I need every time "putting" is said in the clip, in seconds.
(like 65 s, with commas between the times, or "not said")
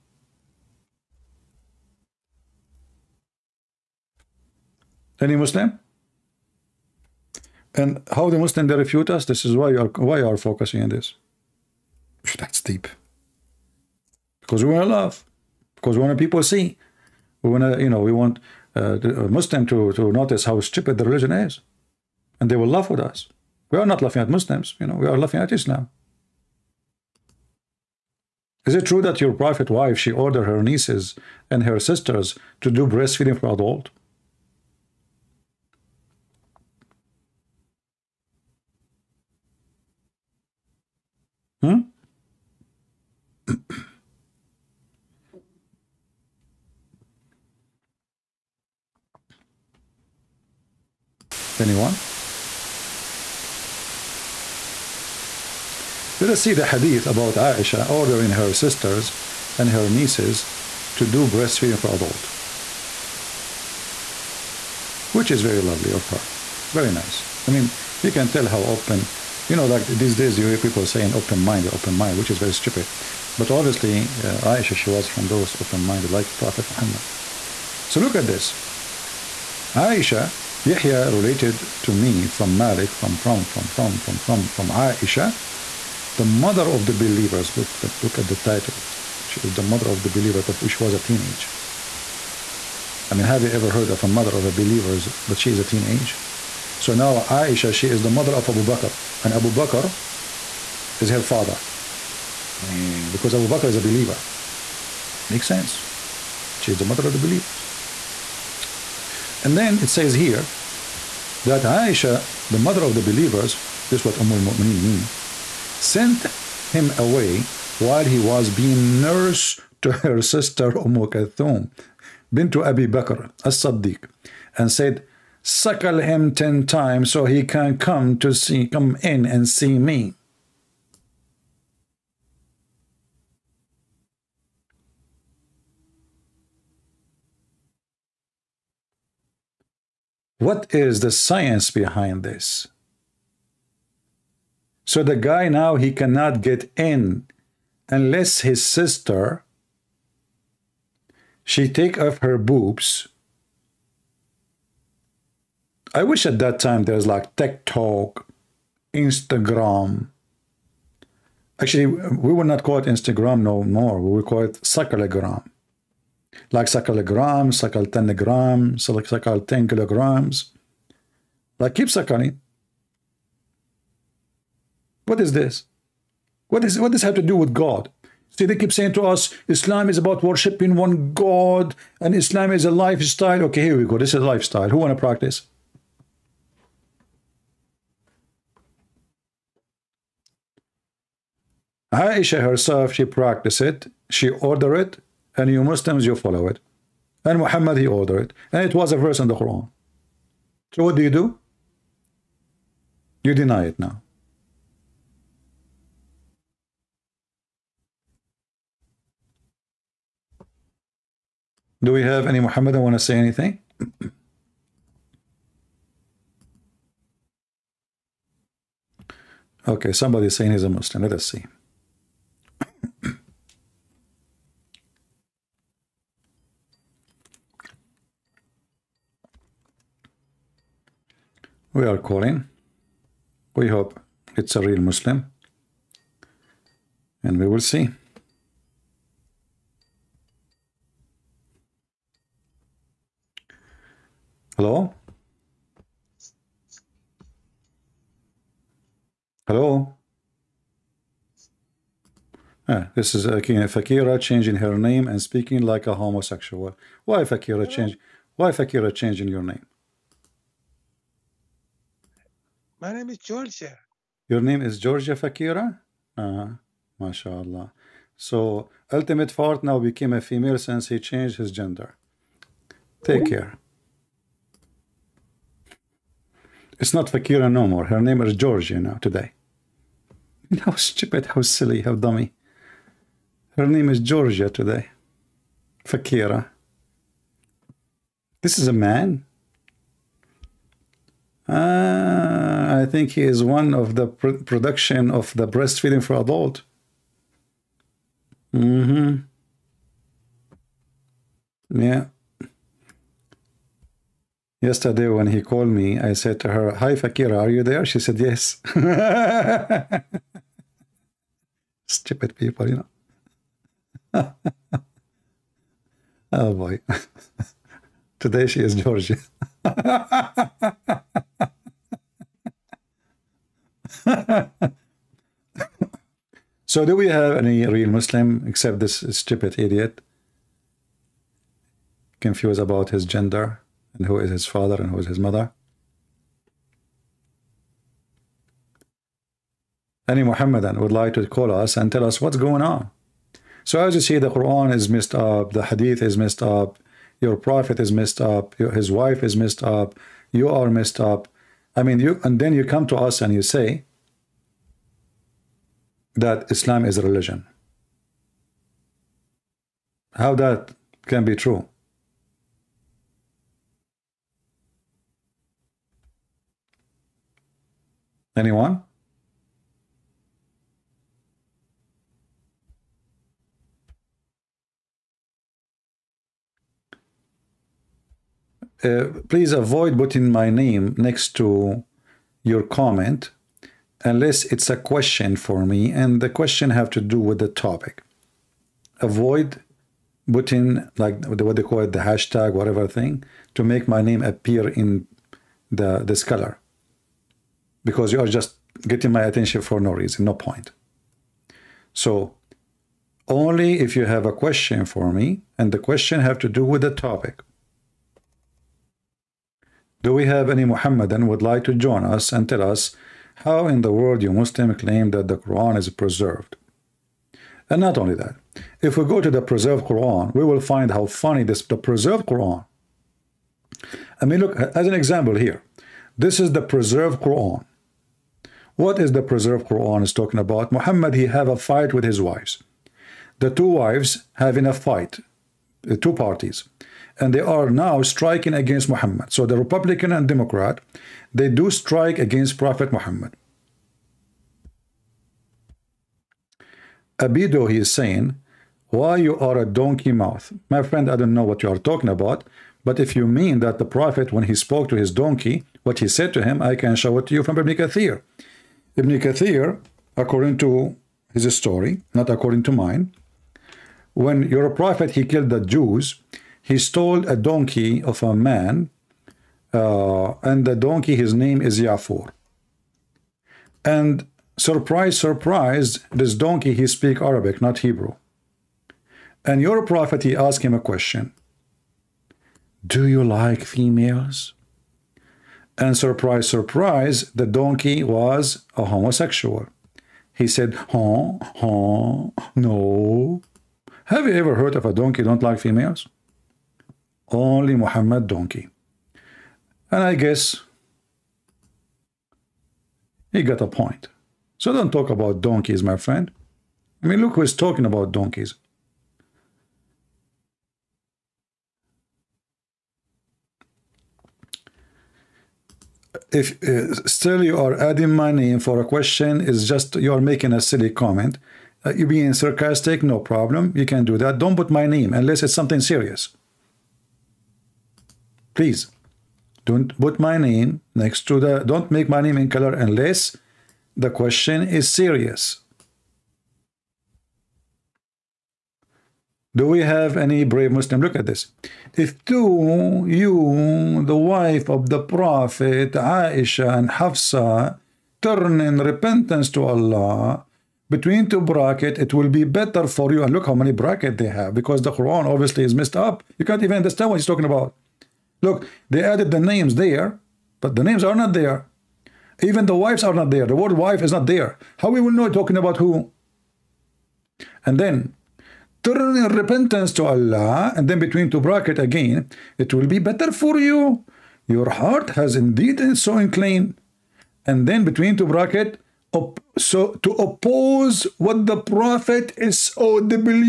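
379 s, 390 s.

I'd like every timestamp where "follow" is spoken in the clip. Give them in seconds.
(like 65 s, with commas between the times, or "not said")
196 s.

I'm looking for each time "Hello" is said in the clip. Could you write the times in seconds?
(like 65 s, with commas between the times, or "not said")
244 s, 249 s.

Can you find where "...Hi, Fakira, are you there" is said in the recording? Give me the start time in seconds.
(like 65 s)
306 s.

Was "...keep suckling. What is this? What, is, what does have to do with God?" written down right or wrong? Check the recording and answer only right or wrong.
right.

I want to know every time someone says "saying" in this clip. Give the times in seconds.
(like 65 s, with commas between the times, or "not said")
70 s, 178 s, 220 s, 447 s.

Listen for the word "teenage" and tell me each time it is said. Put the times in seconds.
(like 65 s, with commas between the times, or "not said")
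90 s, 95 s.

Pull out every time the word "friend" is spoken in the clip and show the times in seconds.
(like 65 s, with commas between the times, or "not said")
450 s, 505 s.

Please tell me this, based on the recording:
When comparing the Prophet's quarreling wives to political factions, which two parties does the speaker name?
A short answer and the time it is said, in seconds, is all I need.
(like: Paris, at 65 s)
Republican and Democrat, at 439 s.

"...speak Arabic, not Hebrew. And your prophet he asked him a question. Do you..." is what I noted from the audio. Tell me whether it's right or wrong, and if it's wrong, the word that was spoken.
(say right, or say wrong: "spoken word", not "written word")
right.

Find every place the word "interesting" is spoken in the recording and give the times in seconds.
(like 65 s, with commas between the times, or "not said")
not said.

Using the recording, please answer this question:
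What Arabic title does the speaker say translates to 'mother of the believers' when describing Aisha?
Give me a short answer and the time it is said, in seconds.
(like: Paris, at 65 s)
Umm al-Mu'mineen, at 114 s.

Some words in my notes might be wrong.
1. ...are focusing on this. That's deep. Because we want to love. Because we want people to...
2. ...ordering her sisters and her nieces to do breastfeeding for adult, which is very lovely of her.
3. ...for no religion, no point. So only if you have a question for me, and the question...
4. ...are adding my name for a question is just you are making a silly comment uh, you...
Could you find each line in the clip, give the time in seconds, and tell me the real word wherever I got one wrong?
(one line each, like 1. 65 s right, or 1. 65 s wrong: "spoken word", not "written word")
1. 10 s right
2. 57 s right
3. 399 s wrong: "reason", not "religion"
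4. 517 s right.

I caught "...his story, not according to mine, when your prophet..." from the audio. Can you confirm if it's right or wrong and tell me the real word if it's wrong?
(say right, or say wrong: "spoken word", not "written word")
right.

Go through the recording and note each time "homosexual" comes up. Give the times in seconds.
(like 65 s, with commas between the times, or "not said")
255 s, 488 s.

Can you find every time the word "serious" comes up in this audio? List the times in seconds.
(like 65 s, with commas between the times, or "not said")
525 s, 534 s.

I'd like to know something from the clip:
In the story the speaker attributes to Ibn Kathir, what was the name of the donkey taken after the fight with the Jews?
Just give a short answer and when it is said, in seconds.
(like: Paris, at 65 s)
Yafur, at 471 s.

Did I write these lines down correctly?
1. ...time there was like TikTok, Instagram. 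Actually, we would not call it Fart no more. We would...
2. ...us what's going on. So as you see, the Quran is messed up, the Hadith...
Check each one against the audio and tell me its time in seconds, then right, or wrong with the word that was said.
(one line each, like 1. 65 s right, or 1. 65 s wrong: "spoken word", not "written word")
1. 156 s wrong: "Instagram", not "Fart"
2. 342 s right.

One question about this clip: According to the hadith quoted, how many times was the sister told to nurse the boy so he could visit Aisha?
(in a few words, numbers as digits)
10.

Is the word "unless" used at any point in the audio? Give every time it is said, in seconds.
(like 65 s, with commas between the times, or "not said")
147 s, 384 s, 525 s, 532 s.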